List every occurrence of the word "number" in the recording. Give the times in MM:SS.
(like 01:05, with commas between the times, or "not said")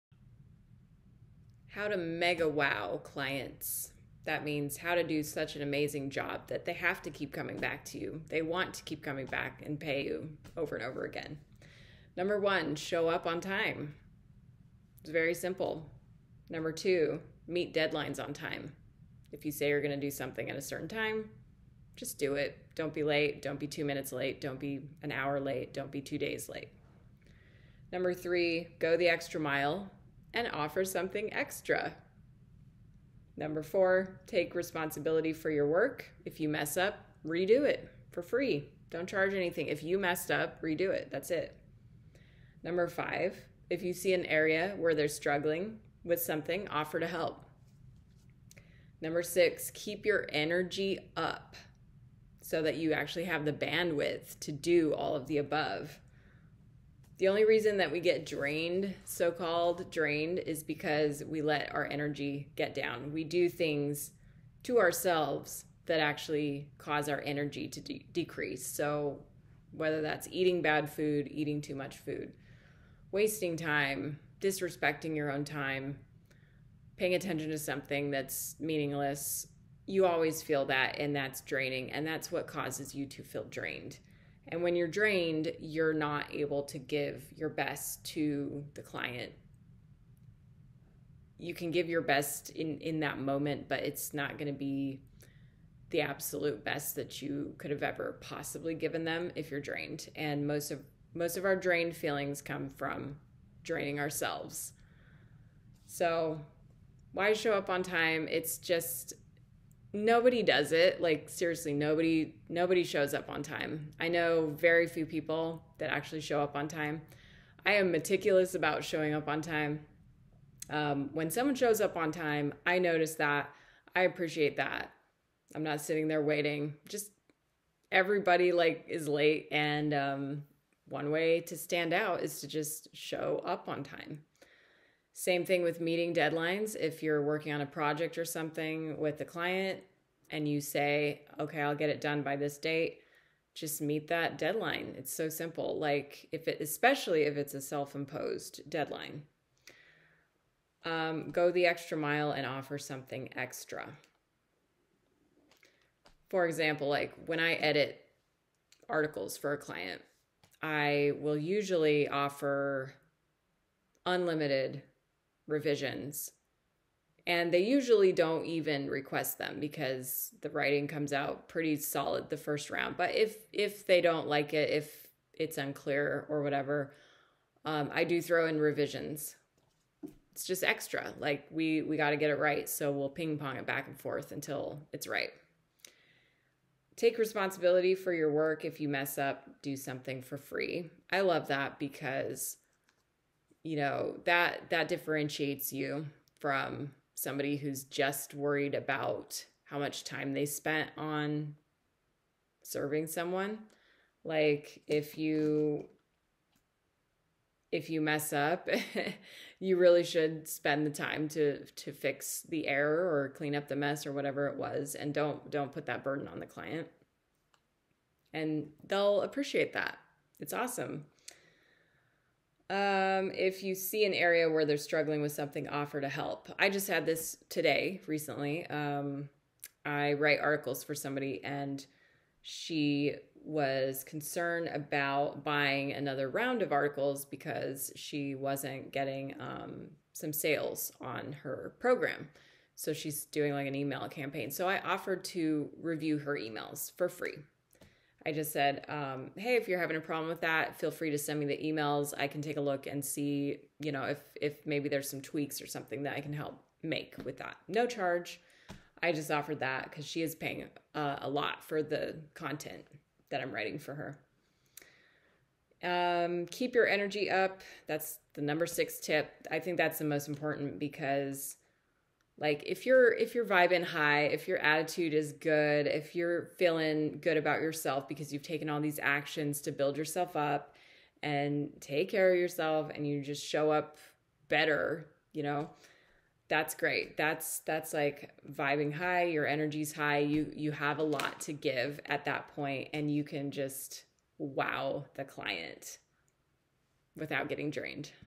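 00:12, 00:16, 00:27, 00:33, 00:42, 00:49, 04:28.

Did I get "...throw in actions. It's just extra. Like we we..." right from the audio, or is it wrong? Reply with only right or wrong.
wrong.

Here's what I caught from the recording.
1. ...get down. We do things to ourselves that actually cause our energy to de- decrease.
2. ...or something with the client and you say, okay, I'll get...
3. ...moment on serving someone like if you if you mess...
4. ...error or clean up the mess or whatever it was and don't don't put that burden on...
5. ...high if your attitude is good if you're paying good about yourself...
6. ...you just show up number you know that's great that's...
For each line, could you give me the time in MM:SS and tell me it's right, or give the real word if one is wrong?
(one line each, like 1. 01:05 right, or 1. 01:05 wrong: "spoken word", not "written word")
1. 01:02 right
2. 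02:18 right
3. 03:20 wrong: "spent", not "moment"
4. 03:32 right
5. 04:33 wrong: "feeling", not "paying"
6. 04:43 wrong: "better", not "number".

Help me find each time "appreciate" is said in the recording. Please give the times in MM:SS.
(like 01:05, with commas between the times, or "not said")
02:04, 03:39.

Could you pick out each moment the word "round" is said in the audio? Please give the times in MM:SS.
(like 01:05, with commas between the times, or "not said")
02:52, 03:56.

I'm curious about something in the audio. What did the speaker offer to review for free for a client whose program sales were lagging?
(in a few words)
her emails.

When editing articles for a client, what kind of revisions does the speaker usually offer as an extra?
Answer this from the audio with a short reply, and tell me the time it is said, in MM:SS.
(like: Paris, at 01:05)
unlimited revisions, at 02:44.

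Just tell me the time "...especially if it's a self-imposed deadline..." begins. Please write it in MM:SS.
02:26.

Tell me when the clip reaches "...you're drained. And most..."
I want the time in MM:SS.
01:39.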